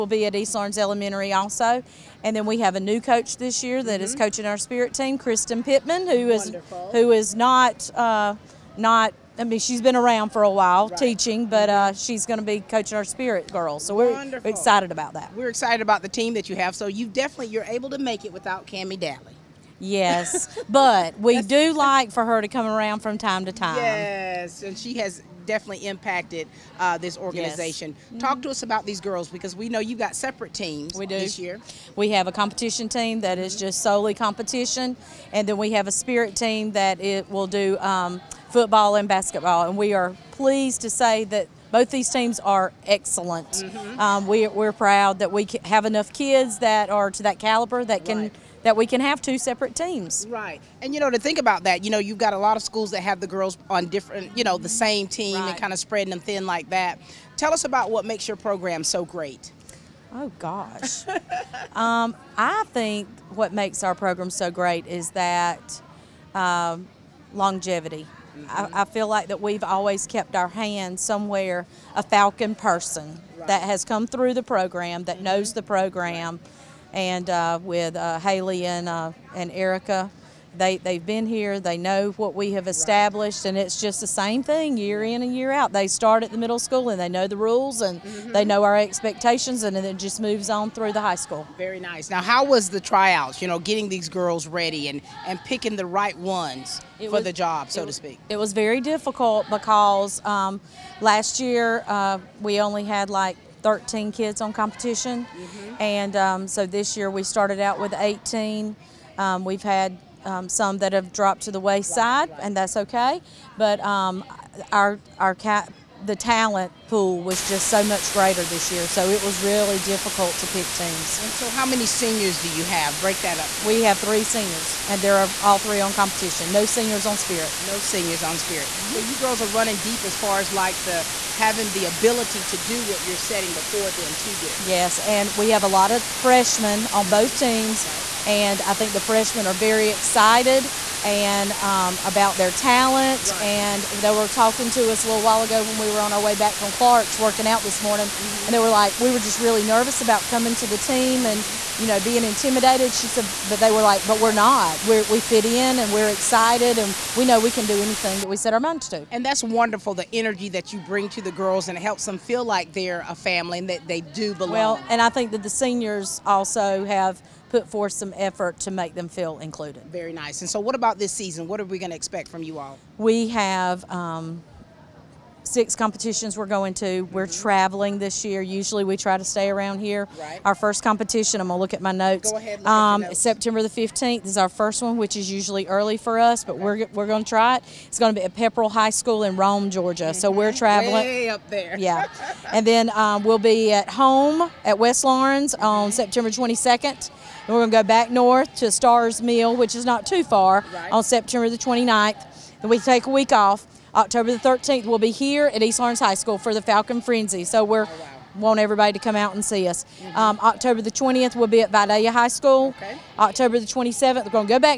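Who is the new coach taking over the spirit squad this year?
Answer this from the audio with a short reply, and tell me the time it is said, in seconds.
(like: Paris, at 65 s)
Kristen Pittman, at 5 s.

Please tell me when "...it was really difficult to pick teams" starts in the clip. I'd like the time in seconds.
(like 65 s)
119 s.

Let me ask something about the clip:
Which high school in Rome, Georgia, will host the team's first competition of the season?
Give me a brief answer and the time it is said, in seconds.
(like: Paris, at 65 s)
Pepperell High School, at 188 s.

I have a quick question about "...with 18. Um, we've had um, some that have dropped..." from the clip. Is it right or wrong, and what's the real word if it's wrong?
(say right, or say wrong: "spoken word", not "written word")
right.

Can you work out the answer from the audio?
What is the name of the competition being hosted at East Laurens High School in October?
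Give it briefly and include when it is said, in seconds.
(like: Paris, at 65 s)
Falcon Frenzy, at 206 s.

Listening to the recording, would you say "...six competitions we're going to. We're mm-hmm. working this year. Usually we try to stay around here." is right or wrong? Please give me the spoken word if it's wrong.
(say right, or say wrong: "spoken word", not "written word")
wrong: "traveling", not "working".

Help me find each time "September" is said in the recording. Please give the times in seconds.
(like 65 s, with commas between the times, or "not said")
183 s, 195 s, 201 s.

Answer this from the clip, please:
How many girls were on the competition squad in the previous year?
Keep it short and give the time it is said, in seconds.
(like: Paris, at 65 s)
13, at 103 s.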